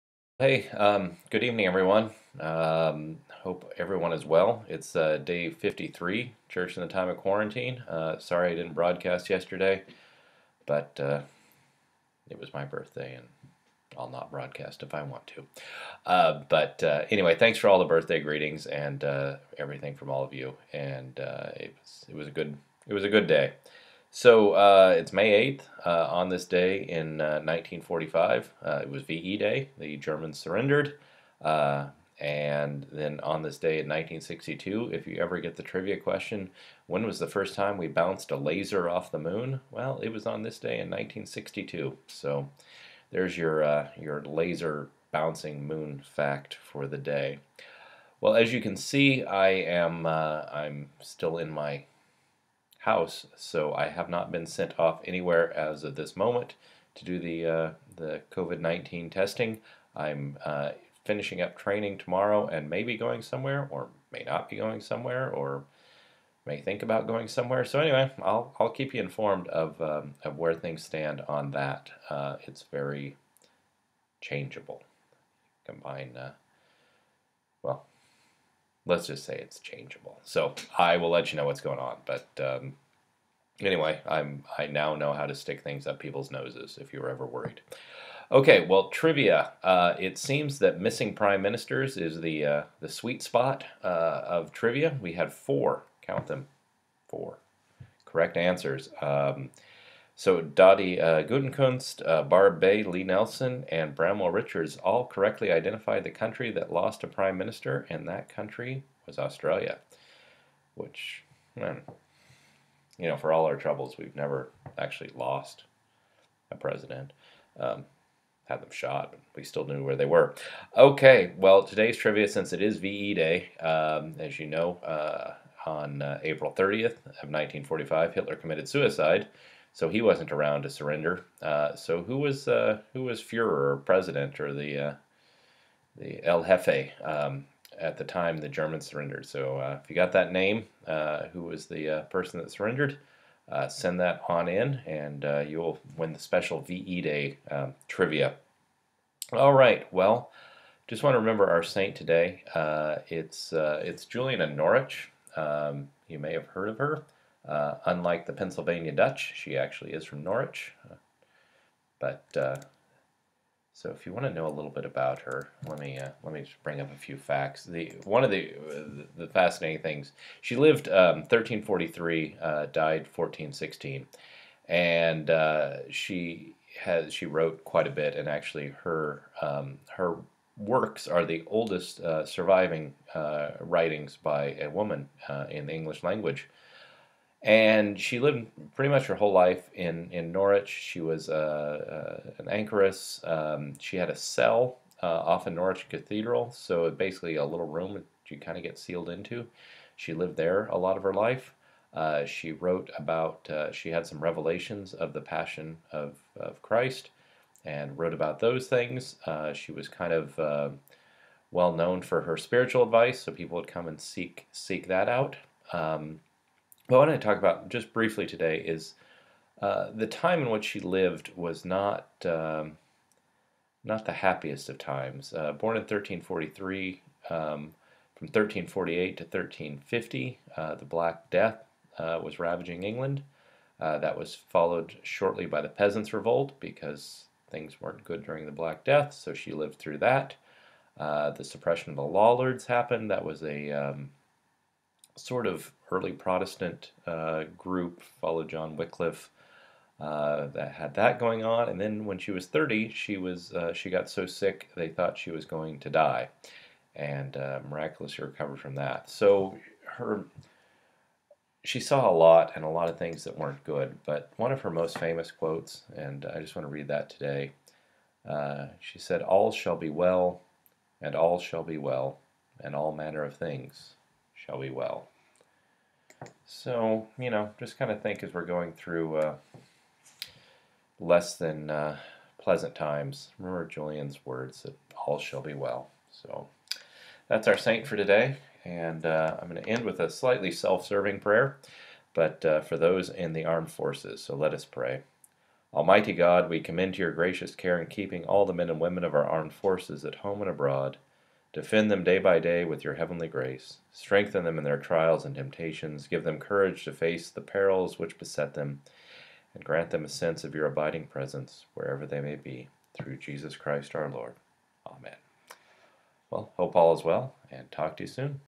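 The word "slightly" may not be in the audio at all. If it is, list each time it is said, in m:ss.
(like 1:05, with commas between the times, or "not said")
4:50.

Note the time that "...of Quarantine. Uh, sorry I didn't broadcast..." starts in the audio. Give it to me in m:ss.
0:07.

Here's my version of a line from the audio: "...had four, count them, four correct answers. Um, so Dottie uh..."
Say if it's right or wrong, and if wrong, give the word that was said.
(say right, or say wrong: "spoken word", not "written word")
right.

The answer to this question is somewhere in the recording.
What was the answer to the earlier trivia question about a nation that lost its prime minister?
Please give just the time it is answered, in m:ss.
1:49.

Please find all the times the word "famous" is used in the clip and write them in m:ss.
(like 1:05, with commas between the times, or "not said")
4:24.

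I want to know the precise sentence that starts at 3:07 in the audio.
And she lived pretty much her whole life in, in Norwich.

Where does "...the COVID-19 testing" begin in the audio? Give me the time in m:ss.
0:57.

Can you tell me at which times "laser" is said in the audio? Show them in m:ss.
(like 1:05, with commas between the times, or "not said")
0:38, 0:44.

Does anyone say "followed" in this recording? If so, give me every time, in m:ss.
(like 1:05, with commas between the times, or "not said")
3:54, 4:08.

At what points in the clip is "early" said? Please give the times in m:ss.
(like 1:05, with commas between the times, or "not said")
4:05.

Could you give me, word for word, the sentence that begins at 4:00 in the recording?
Uh, the suppression of the Lollards happened.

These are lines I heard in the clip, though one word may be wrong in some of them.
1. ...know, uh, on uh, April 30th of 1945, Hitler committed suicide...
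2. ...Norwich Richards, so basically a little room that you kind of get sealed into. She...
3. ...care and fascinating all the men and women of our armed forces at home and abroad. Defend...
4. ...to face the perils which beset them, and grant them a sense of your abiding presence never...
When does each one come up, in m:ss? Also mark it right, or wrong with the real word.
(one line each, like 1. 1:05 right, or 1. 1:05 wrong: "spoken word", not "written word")
1. 2:04 right
2. 3:15 wrong: "Cathedral", not "Richards"
3. 4:57 wrong: "keeping", not "fascinating"
4. 5:06 wrong: "wherever", not "never".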